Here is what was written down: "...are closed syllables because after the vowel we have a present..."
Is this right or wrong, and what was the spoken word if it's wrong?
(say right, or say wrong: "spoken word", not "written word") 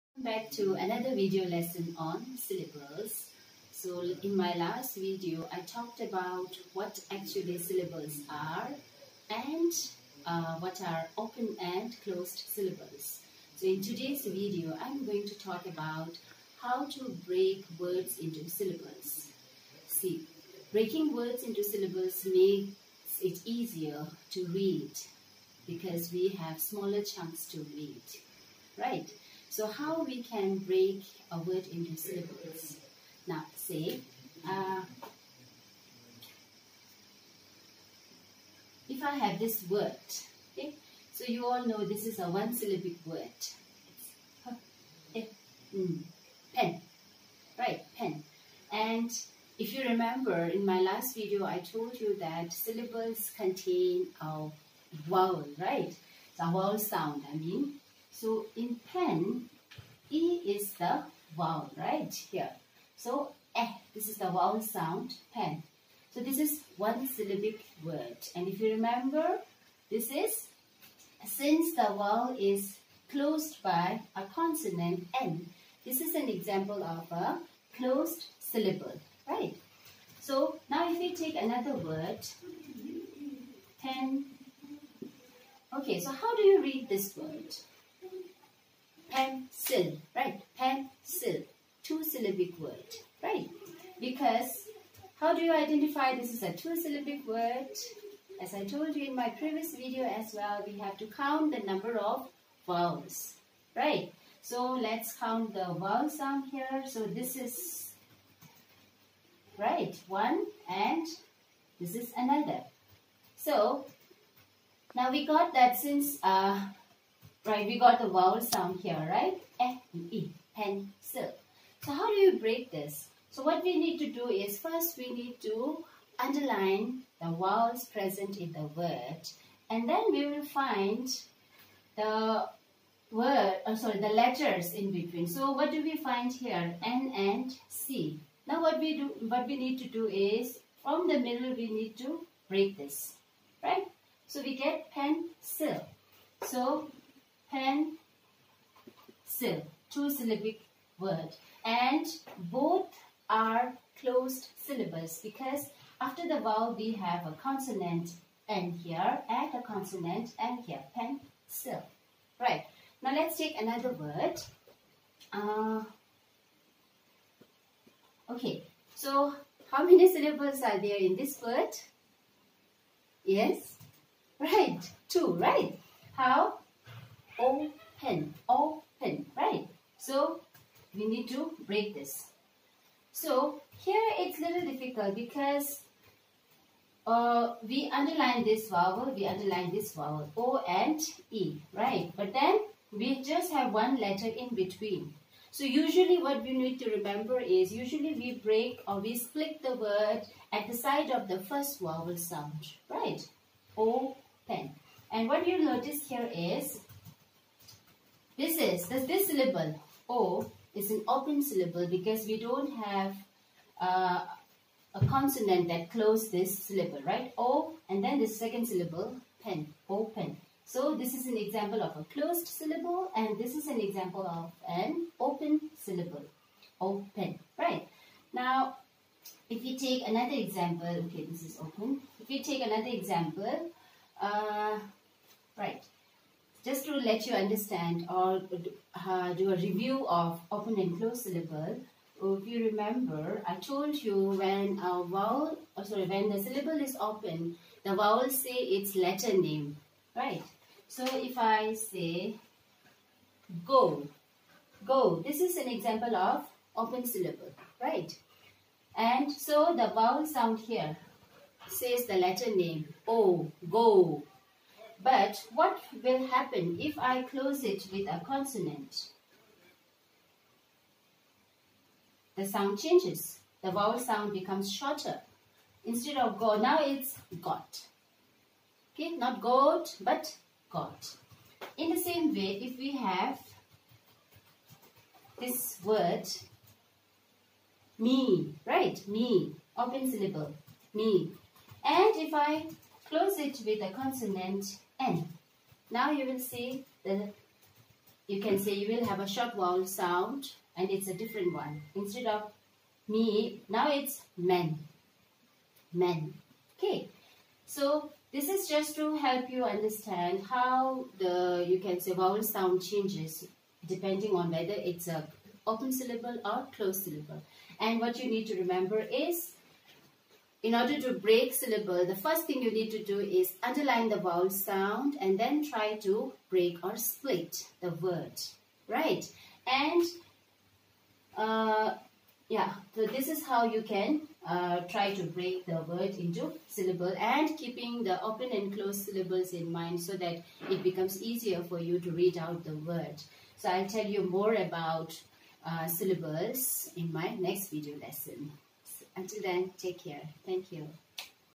wrong: "consonant", not "present".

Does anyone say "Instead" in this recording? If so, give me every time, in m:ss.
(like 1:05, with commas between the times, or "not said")
4:35, 5:01.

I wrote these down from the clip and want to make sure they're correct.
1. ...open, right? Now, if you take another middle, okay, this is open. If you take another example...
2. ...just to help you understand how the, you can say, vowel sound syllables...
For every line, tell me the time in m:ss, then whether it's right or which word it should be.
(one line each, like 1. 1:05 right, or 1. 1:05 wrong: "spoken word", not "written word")
1. 3:46 wrong: "example", not "middle"
2. 5:08 wrong: "changes", not "syllables".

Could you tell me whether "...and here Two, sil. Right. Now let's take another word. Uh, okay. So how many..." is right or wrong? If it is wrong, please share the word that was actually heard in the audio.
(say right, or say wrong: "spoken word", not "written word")
wrong: "Pen", not "Two".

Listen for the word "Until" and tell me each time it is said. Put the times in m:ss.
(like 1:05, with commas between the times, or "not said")
5:49.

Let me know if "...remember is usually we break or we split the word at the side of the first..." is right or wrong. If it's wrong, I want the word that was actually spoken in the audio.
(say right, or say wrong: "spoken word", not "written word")
right.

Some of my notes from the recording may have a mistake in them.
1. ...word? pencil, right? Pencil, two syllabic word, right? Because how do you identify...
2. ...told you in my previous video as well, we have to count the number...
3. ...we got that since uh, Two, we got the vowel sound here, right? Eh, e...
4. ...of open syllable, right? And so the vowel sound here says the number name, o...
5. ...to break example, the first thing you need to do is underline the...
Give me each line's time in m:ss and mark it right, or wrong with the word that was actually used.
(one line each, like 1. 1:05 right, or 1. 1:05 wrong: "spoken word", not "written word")
1. 1:27 right
2. 1:38 right
3. 1:55 wrong: "Right", not "Two"
4. 4:16 wrong: "letter", not "number"
5. 5:21 wrong: "syllable", not "example".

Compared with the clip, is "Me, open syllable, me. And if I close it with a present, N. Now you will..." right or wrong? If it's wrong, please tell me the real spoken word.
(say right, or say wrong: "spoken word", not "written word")
wrong: "consonant", not "present".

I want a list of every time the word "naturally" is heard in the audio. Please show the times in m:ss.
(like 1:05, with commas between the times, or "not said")
not said.